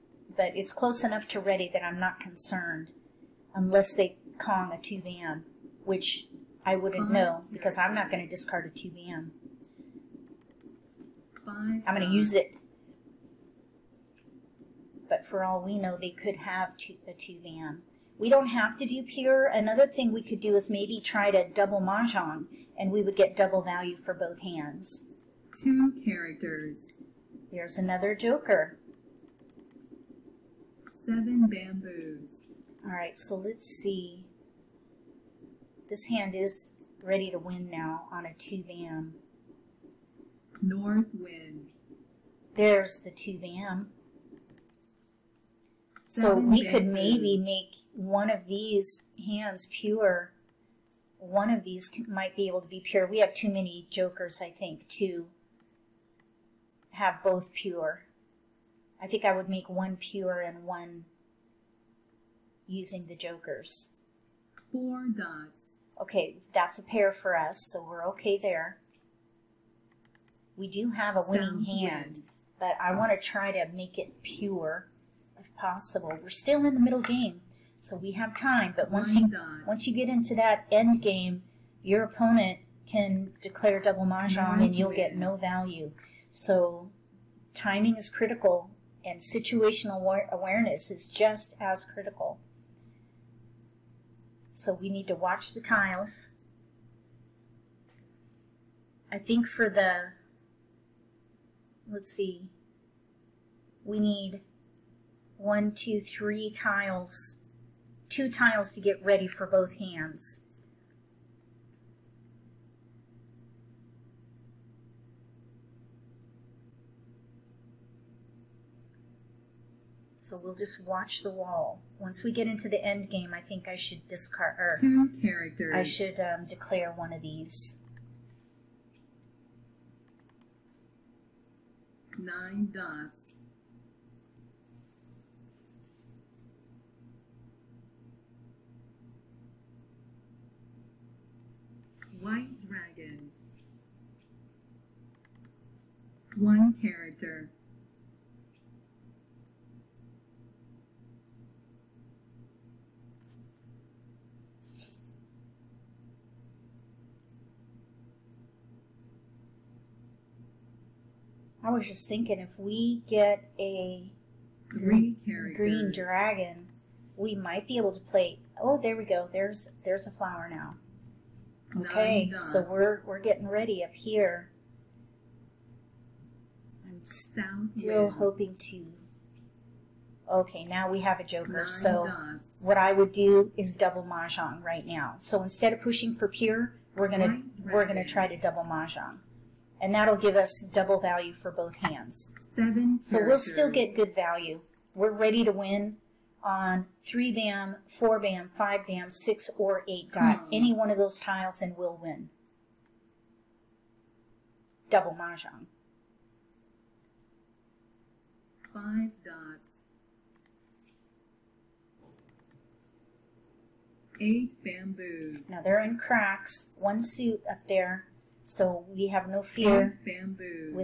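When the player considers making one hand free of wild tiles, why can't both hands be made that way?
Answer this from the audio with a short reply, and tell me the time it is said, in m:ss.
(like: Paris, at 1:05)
too many jokers, at 0:53.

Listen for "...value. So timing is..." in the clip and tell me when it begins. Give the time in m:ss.
1:25.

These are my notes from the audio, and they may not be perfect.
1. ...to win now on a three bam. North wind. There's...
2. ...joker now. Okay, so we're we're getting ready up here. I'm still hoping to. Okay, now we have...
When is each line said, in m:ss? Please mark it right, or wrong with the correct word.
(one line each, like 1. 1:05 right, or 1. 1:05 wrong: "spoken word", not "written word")
1. 0:37 wrong: "two", not "three"
2. 2:50 wrong: "flower", not "joker".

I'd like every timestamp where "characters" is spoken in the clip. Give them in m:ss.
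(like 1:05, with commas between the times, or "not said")
0:26, 2:05, 2:26, 3:13.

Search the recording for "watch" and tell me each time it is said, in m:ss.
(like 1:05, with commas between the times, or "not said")
1:35, 2:00.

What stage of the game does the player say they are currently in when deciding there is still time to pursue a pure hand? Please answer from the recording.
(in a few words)
middle game.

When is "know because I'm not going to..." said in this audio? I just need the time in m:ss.
0:07.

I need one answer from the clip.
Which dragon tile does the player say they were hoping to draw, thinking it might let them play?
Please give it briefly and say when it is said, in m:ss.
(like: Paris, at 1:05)
green dragon, at 2:45.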